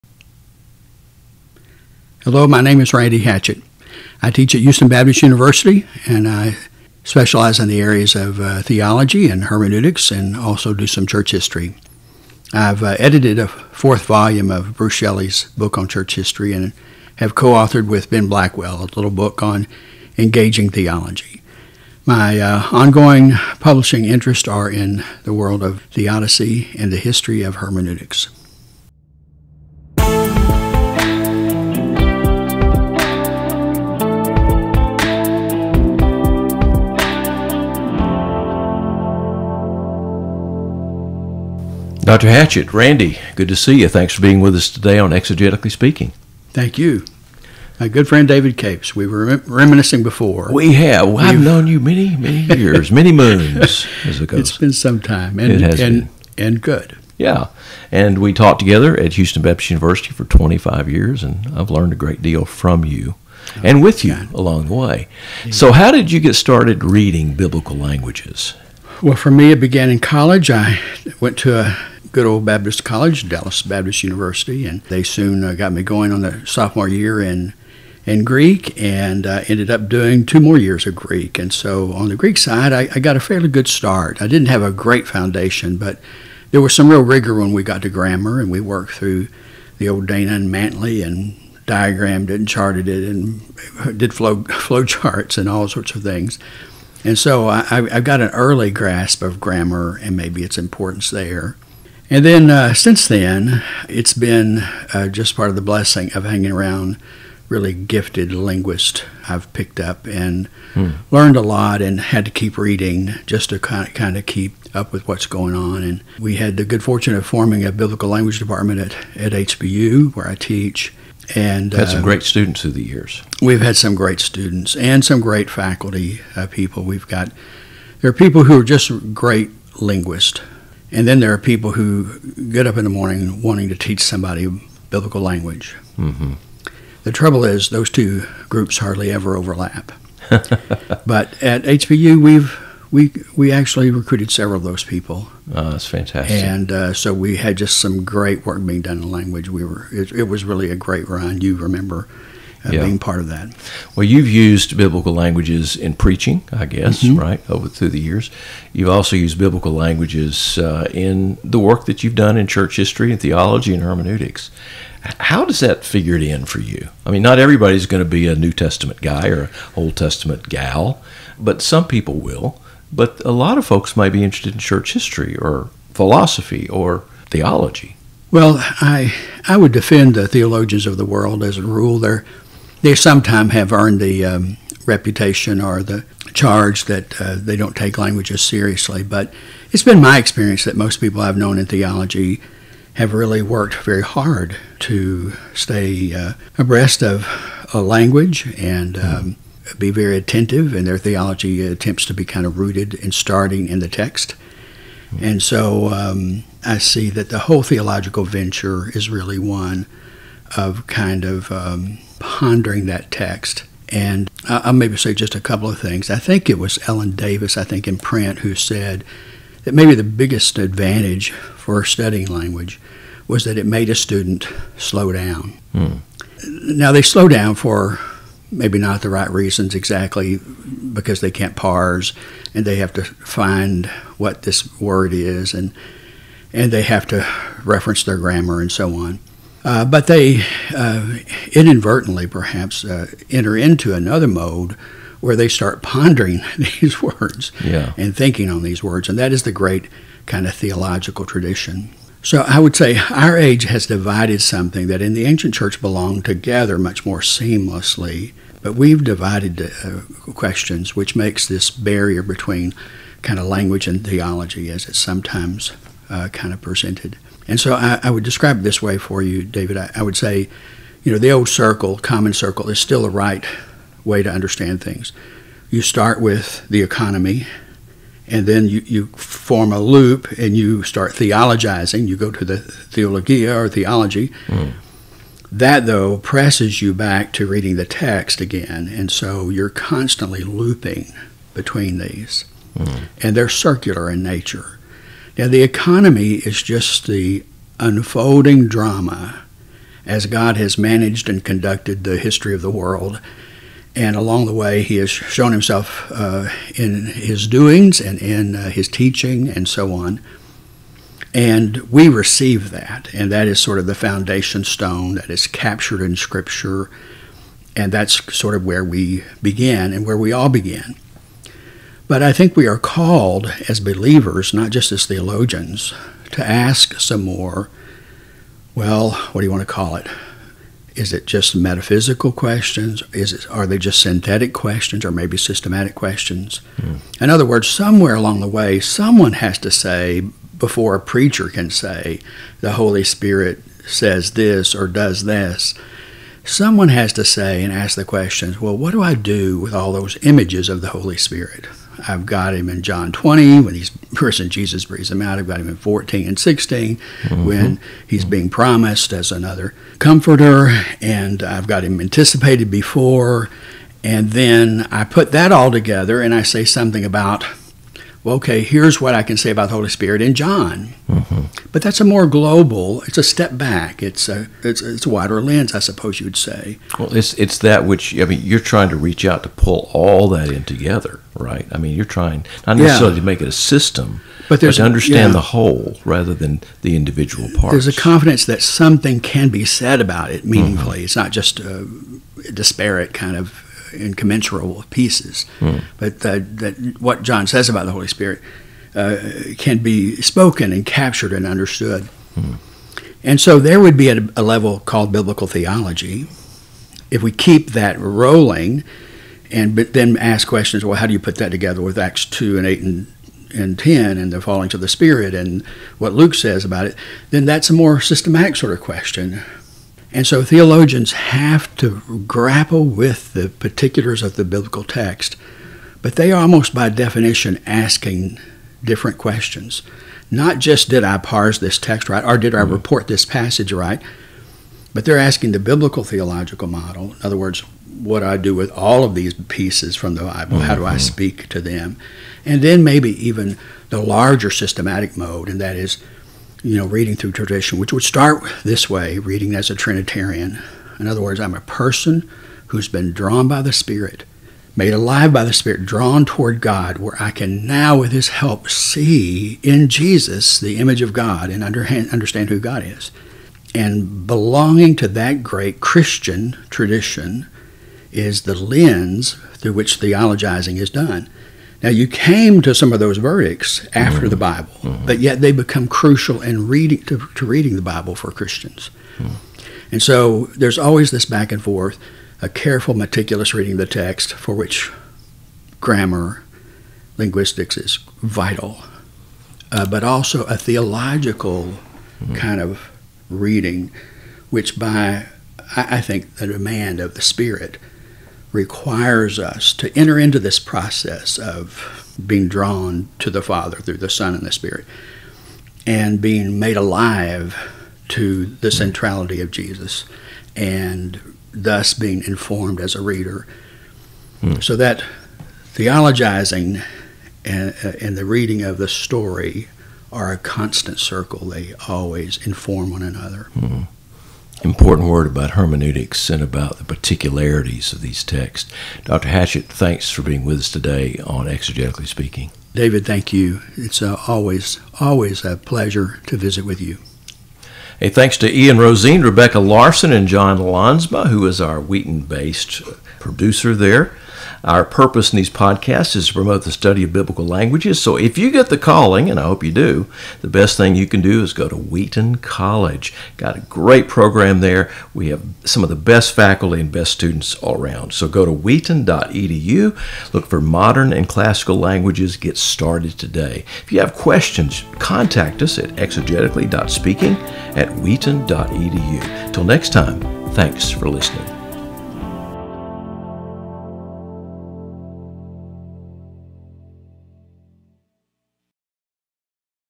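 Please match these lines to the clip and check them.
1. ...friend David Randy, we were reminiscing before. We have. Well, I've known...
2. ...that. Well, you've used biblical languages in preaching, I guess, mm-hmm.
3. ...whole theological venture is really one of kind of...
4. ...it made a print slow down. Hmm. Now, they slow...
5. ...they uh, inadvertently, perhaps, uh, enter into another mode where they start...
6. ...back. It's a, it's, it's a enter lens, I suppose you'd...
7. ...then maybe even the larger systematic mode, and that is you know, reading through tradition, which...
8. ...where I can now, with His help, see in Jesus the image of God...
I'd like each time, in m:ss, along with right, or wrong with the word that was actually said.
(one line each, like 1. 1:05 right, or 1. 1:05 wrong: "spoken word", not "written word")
1. 0:48 wrong: "Capes", not "Randy"
2. 2:33 right
3. 3:27 right
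4. 3:43 wrong: "student", not "print"
5. 4:00 right
6. 6:13 wrong: "wider", not "enter"
7. 7:22 right
8. 7:36 right.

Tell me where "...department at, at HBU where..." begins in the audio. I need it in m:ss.
1:58.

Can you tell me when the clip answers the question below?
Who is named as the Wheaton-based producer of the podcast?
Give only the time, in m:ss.
9:00.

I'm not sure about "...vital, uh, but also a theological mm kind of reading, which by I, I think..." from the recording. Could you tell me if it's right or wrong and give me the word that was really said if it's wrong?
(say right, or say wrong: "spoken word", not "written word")
right.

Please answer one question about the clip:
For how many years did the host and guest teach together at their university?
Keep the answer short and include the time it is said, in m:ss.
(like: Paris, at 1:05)
25, at 1:00.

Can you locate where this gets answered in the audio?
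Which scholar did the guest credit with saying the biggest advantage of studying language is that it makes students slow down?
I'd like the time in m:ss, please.
3:36.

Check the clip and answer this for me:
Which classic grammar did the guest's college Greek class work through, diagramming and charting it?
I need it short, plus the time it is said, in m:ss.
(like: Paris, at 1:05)
Dana and Mantey, at 1:30.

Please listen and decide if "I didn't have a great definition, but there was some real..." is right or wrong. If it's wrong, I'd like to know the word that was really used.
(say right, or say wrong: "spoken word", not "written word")
wrong: "foundation", not "definition".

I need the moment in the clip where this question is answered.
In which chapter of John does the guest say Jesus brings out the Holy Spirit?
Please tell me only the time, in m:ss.
5:52.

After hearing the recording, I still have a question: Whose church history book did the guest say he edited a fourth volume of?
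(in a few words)
Bruce Shelley.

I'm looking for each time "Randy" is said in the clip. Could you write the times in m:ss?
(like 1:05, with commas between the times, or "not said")
0:02, 0:42.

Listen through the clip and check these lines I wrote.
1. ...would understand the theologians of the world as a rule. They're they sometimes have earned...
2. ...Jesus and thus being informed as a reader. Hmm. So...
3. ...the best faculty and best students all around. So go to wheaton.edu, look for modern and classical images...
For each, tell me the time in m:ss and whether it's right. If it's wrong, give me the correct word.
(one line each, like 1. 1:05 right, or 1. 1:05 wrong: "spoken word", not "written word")
1. 2:59 wrong: "defend", not "understand"
2. 8:29 right
3. 9:15 wrong: "languages", not "images".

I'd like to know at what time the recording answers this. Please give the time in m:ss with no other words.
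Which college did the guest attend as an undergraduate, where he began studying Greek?
1:13.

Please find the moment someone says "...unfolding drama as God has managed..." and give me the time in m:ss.
4:57.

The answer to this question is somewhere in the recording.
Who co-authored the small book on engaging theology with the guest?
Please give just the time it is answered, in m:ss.
0:18.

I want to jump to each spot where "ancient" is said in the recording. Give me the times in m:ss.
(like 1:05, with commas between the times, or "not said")
4:15.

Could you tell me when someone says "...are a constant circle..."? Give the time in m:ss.
8:40.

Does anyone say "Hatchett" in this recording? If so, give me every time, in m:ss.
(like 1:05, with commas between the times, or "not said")
0:03, 0:42, 8:49.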